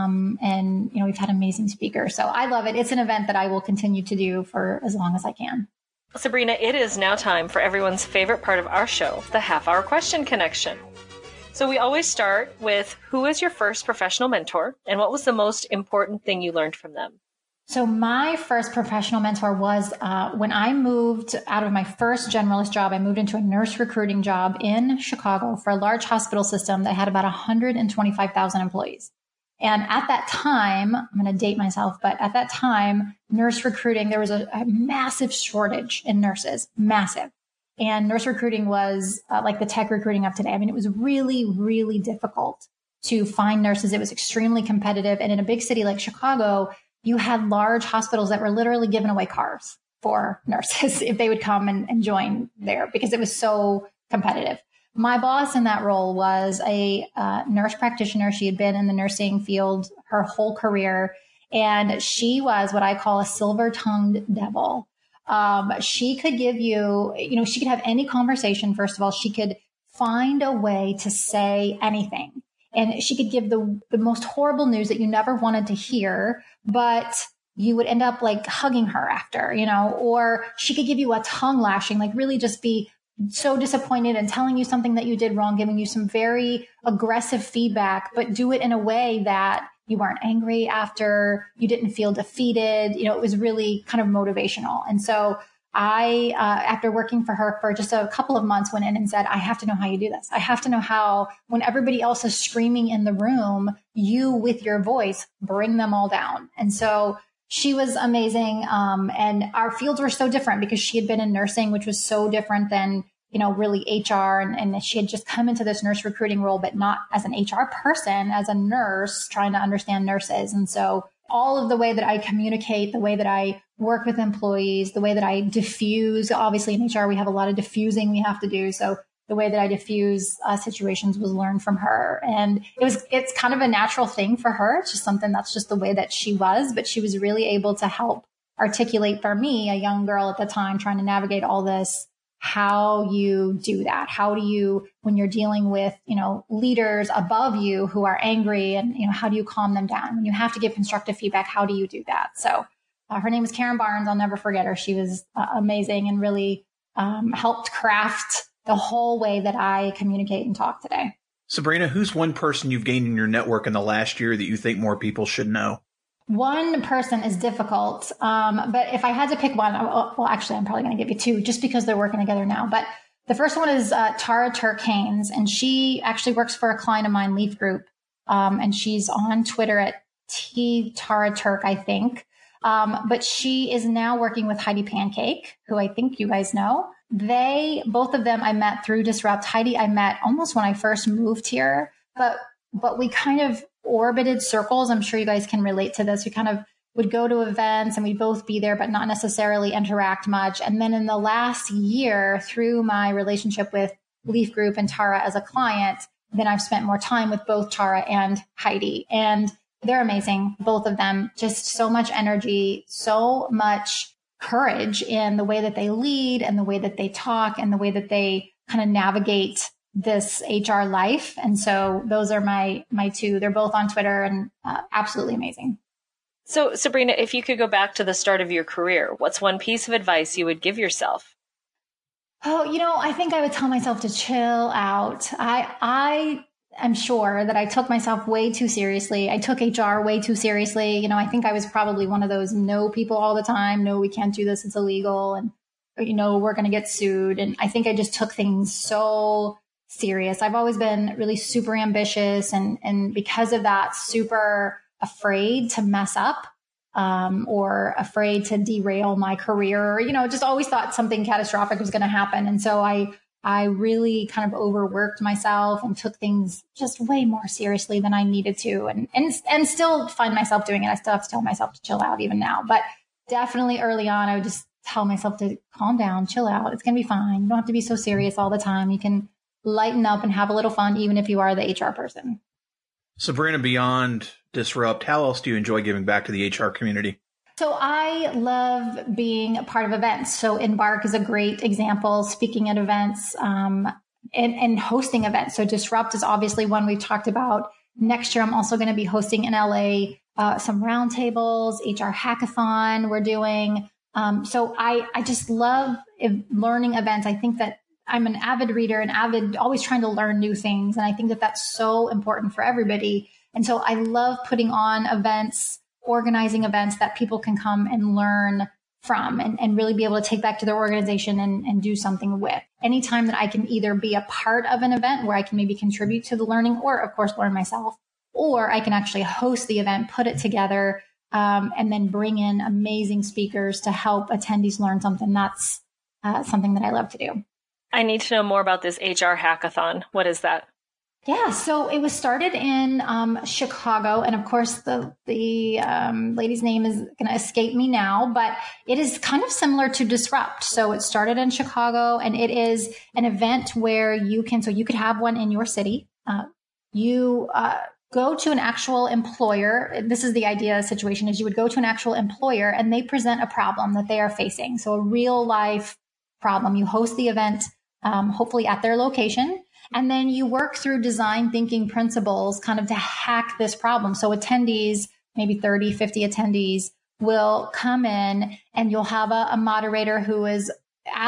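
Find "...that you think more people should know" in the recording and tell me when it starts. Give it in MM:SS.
02:44.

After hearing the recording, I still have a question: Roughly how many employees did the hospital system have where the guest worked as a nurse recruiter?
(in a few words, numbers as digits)
125,000.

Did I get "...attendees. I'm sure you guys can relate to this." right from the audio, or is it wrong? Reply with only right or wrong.
wrong.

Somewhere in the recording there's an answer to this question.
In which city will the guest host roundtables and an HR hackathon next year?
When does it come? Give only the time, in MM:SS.
04:59.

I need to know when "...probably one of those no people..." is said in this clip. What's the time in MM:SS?
04:01.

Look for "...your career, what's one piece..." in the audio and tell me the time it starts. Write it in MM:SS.
03:48.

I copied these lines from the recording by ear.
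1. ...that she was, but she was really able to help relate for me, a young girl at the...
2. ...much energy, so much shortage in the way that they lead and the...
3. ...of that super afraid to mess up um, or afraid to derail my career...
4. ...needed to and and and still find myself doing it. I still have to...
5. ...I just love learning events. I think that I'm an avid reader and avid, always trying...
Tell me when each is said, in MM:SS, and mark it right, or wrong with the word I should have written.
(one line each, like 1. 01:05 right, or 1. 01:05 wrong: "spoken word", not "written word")
1. 02:15 wrong: "articulate", not "relate"
2. 03:31 wrong: "courage", not "shortage"
3. 04:13 right
4. 04:28 right
5. 05:05 right.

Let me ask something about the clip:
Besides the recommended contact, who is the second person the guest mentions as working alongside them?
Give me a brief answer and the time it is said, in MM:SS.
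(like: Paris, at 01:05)
Heidi Pancake, at 03:04.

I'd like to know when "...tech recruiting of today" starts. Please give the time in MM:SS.
00:39.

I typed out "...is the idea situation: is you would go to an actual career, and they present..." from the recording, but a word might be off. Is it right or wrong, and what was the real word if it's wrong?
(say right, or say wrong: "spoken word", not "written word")
wrong: "employer", not "career".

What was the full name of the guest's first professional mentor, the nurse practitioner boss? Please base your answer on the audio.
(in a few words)
Karen Barnes.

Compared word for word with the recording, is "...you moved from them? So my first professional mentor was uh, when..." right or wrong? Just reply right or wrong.
wrong.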